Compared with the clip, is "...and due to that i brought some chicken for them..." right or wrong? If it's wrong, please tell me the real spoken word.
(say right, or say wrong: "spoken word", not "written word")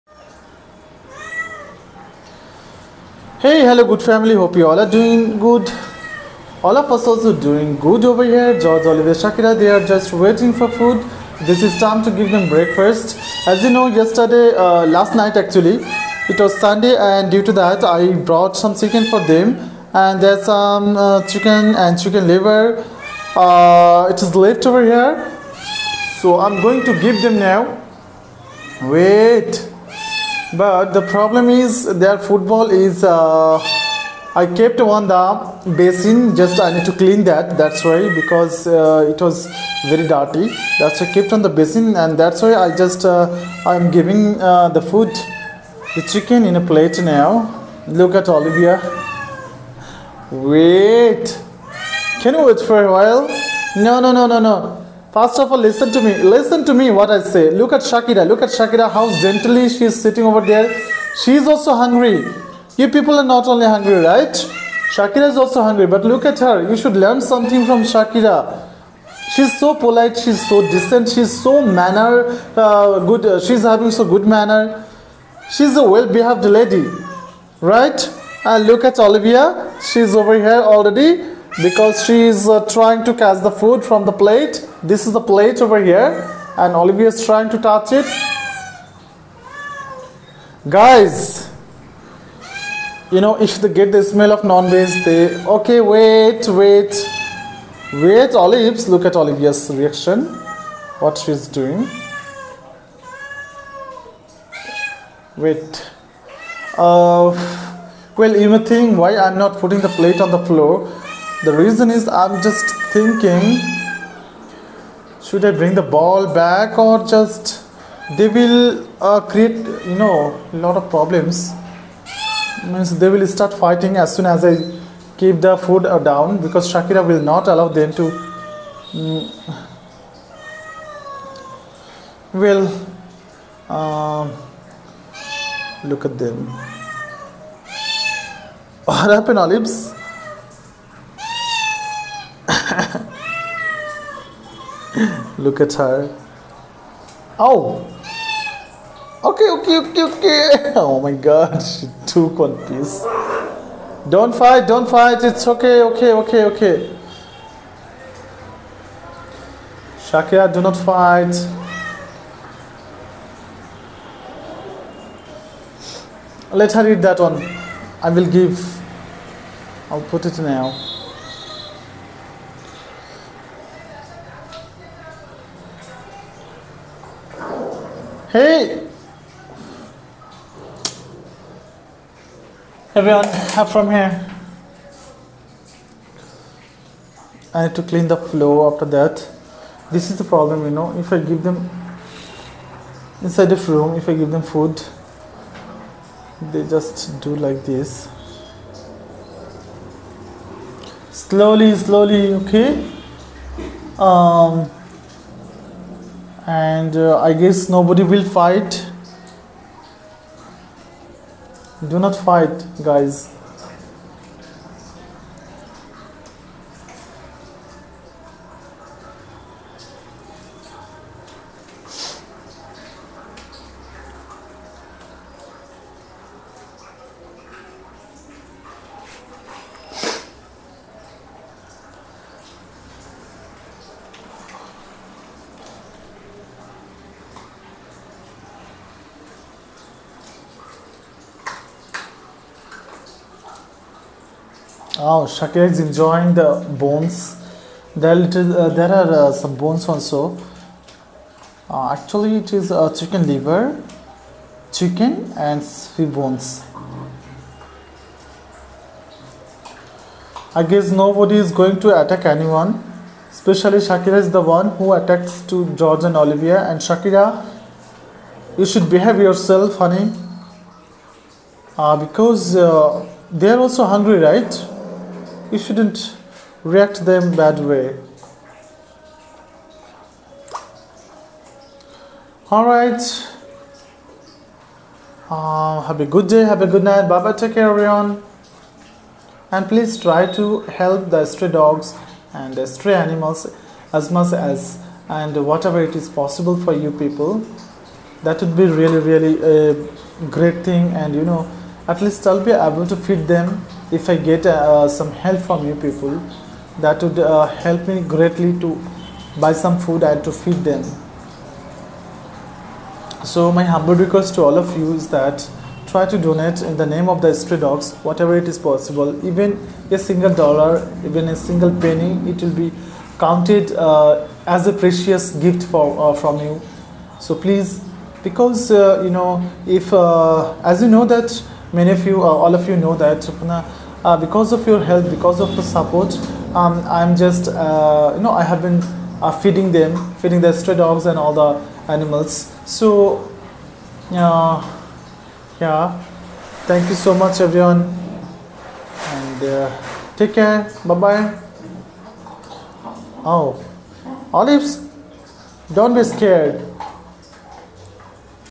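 right.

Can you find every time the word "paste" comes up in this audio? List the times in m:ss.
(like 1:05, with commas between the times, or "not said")
not said.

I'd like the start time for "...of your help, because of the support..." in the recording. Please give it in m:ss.
5:34.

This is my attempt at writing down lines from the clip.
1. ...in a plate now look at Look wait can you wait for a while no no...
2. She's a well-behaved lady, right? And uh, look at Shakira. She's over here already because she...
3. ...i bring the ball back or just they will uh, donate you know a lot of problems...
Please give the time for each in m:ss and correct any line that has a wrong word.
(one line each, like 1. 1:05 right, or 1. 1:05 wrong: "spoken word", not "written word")
1. 0:46 wrong: "Olivia", not "Look"
2. 1:15 wrong: "Olivia", not "Shakira"
3. 1:55 wrong: "create", not "donate".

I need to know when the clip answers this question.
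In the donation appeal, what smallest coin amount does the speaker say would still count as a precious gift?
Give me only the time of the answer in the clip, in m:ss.
5:21.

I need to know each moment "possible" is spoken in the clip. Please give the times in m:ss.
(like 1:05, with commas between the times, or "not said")
4:56, 5:18.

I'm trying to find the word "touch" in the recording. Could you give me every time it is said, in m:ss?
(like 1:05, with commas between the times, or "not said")
1:27.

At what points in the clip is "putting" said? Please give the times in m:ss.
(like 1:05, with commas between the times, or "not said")
1:49.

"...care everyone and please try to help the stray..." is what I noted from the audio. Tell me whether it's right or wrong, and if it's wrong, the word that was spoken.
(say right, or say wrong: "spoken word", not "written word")
right.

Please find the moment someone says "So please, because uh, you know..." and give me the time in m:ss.
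5:27.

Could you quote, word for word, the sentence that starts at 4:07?
There, little, uh, there are uh, some bones also.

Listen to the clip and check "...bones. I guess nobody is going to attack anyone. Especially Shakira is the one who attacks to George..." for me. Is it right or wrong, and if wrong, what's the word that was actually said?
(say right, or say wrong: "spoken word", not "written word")
right.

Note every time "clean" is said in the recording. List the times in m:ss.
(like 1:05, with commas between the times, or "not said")
0:36, 3:07.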